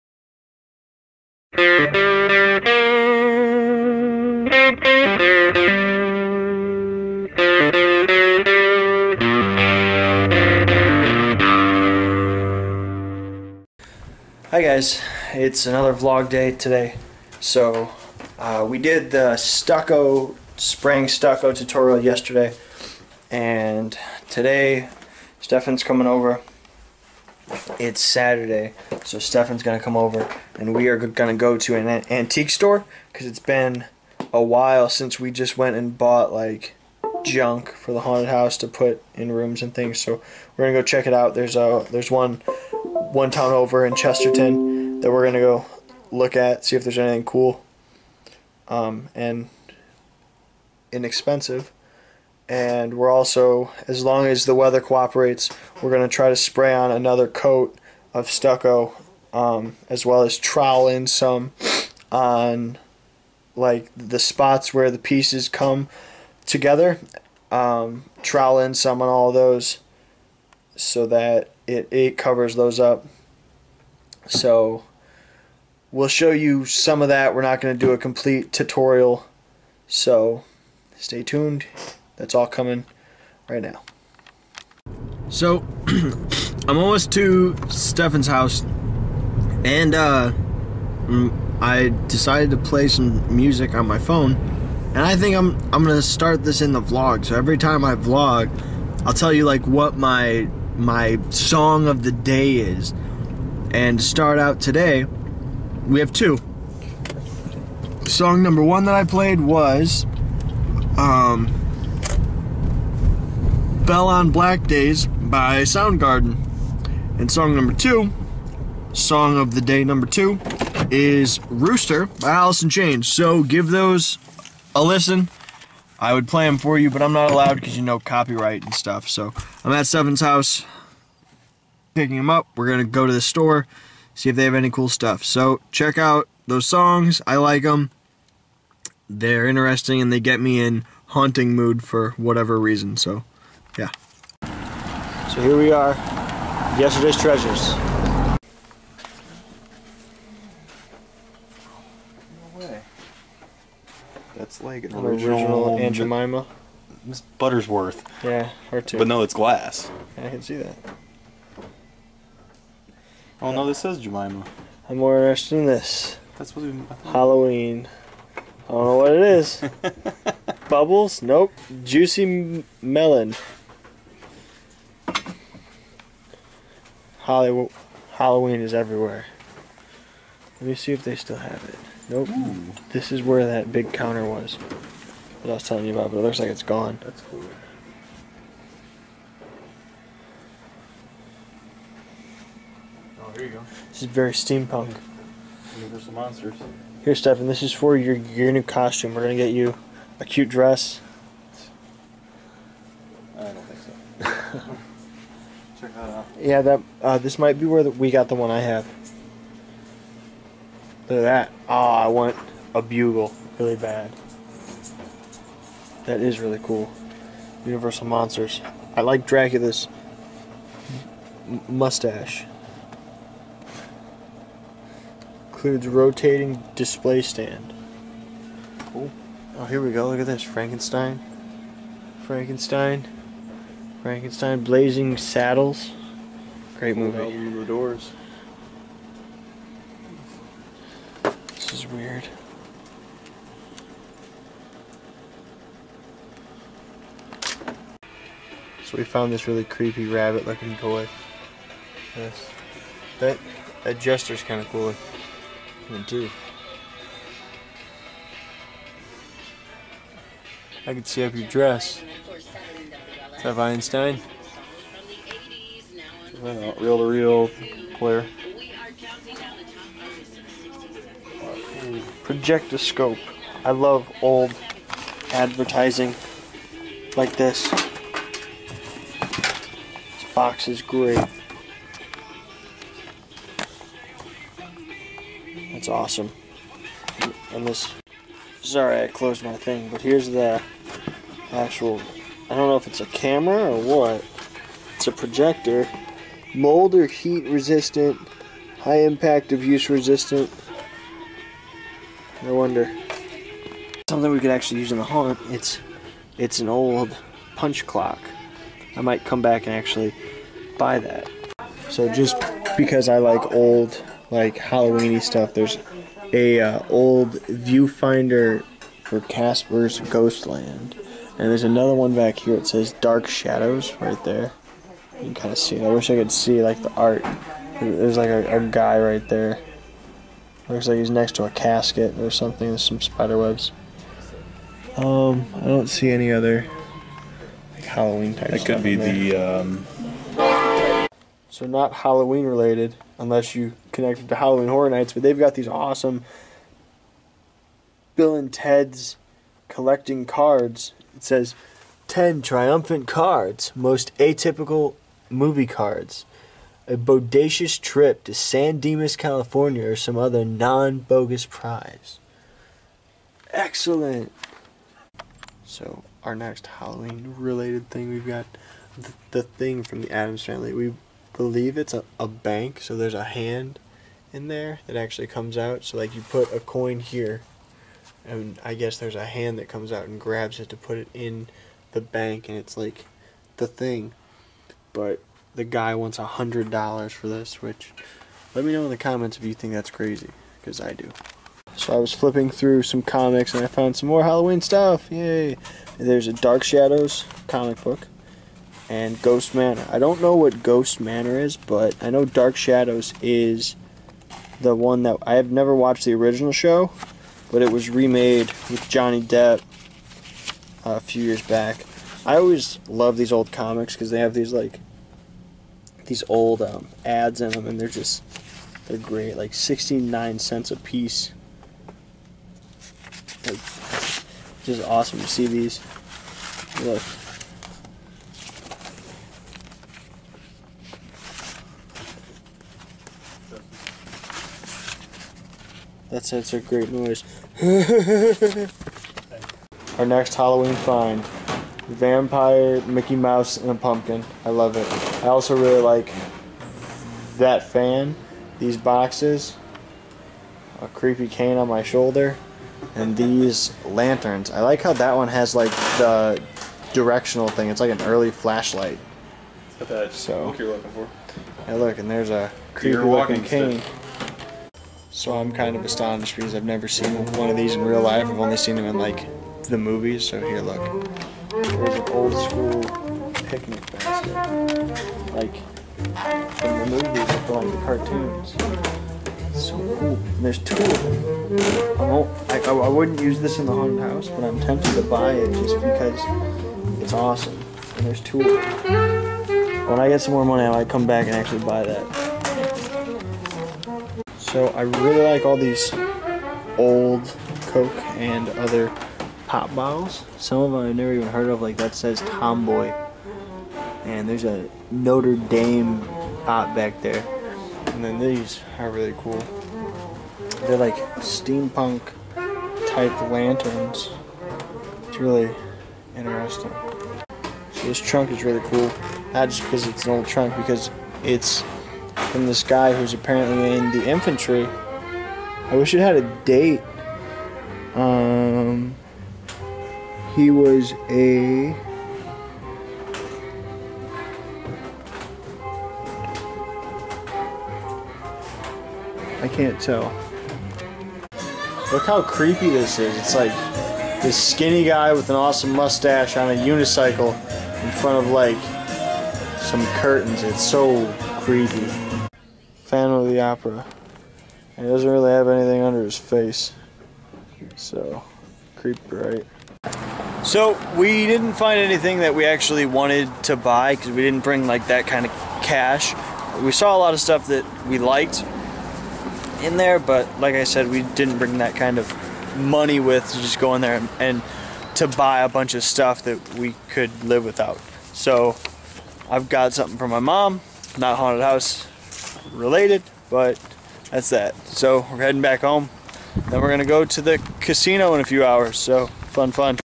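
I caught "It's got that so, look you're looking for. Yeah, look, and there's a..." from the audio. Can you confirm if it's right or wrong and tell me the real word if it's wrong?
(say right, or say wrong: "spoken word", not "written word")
right.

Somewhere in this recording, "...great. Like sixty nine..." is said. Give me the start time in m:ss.
6:58.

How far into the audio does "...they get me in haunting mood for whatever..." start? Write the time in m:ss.
2:20.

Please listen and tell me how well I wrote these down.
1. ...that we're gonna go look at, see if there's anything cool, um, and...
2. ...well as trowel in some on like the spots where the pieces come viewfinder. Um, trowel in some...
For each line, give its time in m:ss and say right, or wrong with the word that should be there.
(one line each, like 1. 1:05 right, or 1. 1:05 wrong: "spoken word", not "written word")
1. 0:45 right
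2. 1:00 wrong: "together", not "viewfinder".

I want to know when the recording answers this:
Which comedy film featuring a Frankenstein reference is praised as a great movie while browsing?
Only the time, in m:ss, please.
3:54.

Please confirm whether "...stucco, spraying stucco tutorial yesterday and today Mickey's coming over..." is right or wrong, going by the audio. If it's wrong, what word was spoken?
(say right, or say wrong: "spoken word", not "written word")
wrong: "Stefan", not "Mickey".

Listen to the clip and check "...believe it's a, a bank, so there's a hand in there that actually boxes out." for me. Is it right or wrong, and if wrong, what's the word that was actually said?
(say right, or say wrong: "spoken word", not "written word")
wrong: "comes", not "boxes".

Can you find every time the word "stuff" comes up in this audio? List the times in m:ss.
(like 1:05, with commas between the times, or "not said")
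2:08, 2:14, 5:15, 6:34, 9:27, 9:35.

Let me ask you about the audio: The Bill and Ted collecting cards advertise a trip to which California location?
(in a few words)
San Dimas.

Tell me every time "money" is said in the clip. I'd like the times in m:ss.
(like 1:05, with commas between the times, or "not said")
8:10, 9:32.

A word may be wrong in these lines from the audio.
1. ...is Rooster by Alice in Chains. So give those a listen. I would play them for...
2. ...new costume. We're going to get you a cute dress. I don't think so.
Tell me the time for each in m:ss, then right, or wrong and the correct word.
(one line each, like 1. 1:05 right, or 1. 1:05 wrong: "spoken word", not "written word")
1. 2:00 right
2. 3:18 right.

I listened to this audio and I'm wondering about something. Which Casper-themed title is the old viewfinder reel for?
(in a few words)
Casper's Ghostland.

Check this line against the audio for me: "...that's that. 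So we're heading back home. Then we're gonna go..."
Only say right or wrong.
right.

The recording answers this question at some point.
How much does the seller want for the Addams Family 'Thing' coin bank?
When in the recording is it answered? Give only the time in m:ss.
6:26.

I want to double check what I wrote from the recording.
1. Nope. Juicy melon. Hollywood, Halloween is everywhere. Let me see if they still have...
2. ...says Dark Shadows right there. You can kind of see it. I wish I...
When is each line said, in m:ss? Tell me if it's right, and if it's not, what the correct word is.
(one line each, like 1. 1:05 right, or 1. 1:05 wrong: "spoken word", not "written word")
1. 2:51 right
2. 5:22 right.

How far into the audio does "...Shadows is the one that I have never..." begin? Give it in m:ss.
6:42.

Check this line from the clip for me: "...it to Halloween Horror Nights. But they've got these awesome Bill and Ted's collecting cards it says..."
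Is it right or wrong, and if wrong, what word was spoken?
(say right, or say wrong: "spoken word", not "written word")
right.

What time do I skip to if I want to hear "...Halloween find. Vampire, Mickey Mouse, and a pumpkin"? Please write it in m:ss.
7:20.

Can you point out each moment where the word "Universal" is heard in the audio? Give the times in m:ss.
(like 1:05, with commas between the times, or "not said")
3:15, 3:37.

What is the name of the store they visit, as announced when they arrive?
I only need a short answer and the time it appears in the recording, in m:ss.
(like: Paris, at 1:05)
Yesterday's Treasures, at 2:26.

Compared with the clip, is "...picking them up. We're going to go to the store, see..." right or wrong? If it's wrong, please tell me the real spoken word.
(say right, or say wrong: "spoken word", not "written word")
right.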